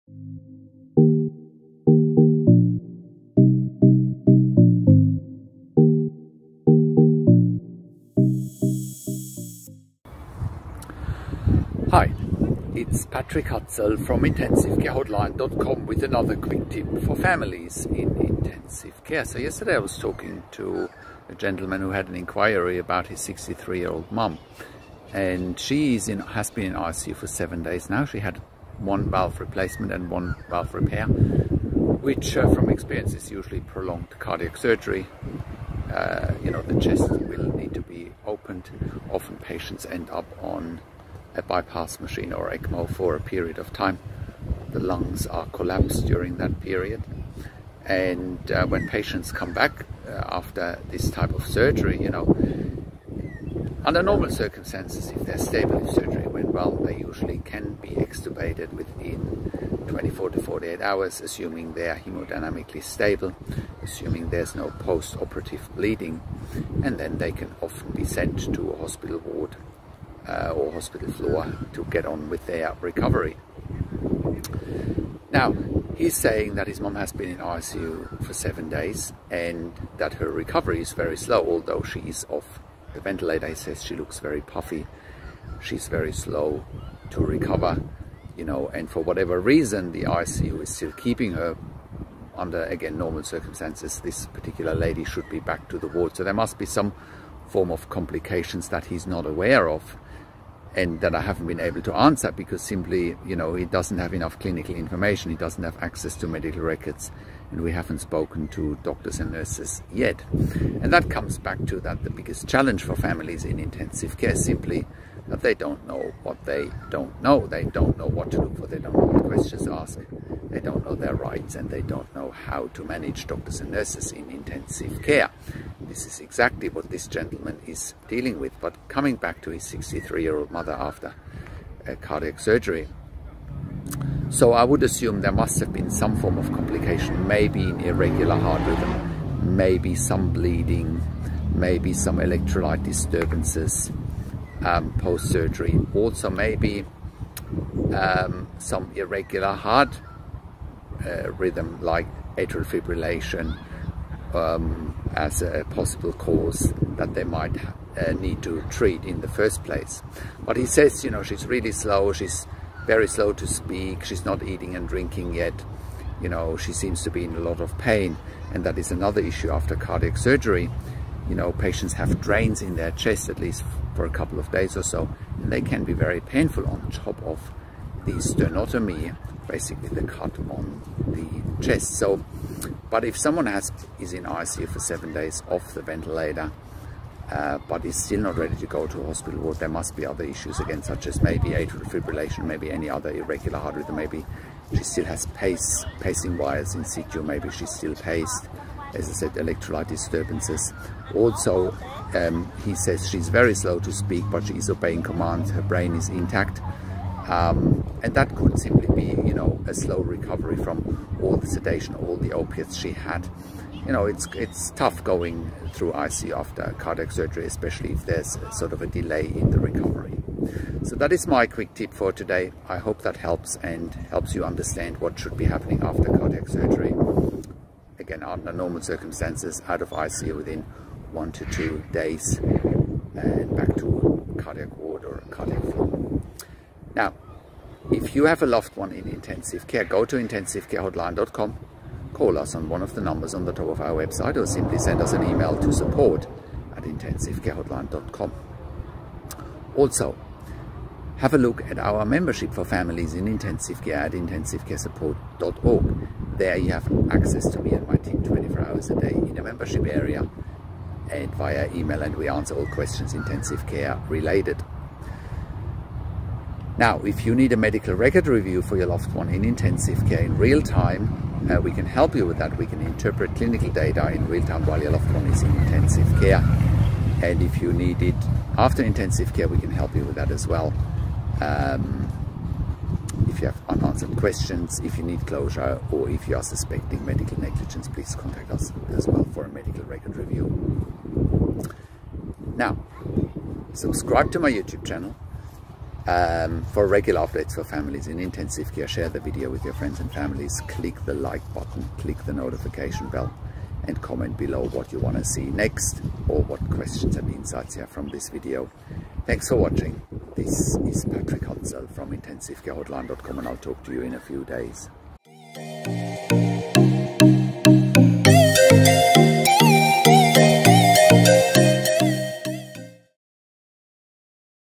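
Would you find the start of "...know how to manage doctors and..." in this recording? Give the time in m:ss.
2:02.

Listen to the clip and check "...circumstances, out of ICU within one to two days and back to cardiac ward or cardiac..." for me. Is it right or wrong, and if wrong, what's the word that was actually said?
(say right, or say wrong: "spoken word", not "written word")
right.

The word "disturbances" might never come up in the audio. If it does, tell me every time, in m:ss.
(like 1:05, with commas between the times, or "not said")
2:22, 3:19.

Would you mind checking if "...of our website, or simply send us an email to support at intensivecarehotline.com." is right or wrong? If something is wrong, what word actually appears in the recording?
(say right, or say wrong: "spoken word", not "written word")
right.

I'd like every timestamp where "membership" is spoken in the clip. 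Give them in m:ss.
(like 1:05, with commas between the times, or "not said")
4:12, 4:19.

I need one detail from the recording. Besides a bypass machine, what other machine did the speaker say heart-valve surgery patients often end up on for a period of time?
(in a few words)
ECMO.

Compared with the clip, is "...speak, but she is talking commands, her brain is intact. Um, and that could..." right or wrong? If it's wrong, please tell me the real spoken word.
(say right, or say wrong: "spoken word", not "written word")
wrong: "obeying", not "talking".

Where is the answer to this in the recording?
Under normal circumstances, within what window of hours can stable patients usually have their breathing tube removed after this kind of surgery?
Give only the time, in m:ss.
0:59.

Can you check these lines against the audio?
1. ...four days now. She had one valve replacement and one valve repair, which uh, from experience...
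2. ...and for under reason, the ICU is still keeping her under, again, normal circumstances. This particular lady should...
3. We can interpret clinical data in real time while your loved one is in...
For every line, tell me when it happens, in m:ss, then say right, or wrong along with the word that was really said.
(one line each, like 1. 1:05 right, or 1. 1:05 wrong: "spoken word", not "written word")
1. 0:27 wrong: "seven", not "four"
2. 1:28 wrong: "whatever", not "under"
3. 4:32 right.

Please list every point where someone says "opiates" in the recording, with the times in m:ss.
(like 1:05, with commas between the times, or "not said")
3:32.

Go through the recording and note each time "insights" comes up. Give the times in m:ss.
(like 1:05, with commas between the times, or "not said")
5:07.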